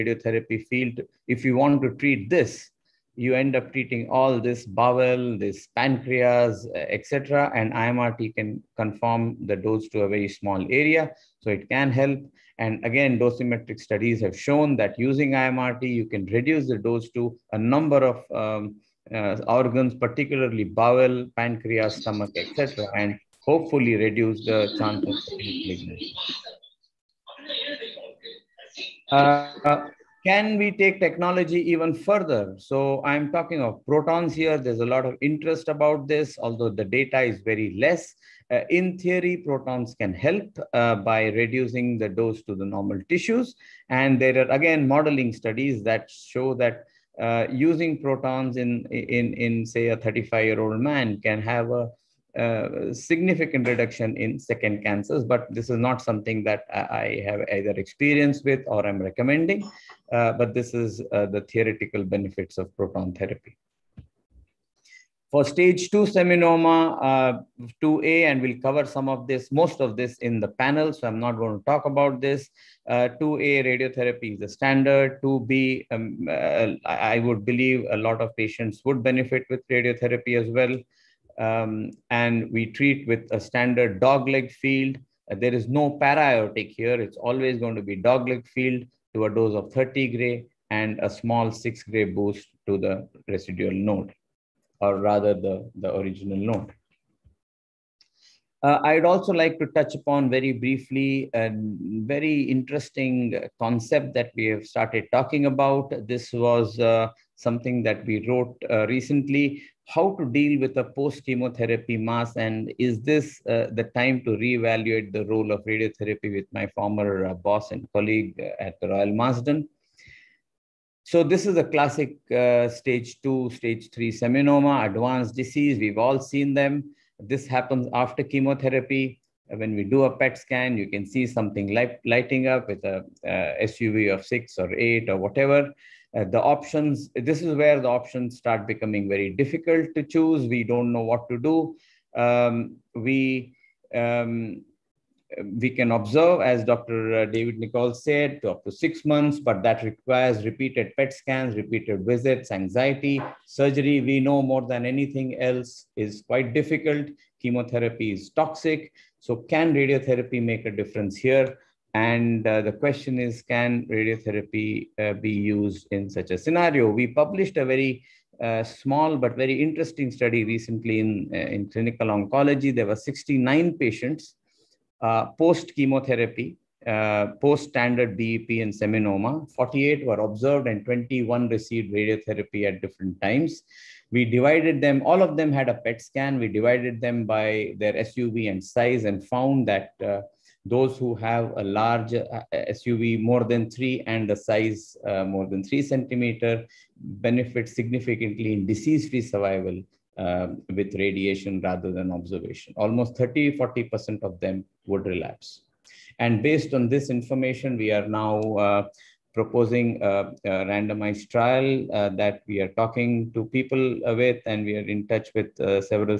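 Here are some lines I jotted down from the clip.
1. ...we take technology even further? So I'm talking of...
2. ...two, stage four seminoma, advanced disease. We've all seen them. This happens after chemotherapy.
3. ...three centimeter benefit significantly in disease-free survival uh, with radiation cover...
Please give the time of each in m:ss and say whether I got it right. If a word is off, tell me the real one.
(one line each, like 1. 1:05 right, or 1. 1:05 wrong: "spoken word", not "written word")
1. 0:30 right
2. 2:03 wrong: "three", not "four"
3. 3:15 wrong: "rather", not "cover".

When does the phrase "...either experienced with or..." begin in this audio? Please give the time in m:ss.
0:57.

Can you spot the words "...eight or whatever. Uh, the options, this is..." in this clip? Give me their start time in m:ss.
2:14.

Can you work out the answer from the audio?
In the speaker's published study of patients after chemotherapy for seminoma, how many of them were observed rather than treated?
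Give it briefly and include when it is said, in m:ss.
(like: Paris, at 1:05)
48, at 2:59.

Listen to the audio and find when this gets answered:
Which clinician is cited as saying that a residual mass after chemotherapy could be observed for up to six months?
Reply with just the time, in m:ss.
2:27.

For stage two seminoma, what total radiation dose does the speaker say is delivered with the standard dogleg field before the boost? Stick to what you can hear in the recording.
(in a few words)
30 gray.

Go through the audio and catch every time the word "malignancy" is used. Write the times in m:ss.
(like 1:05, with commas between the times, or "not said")
0:25.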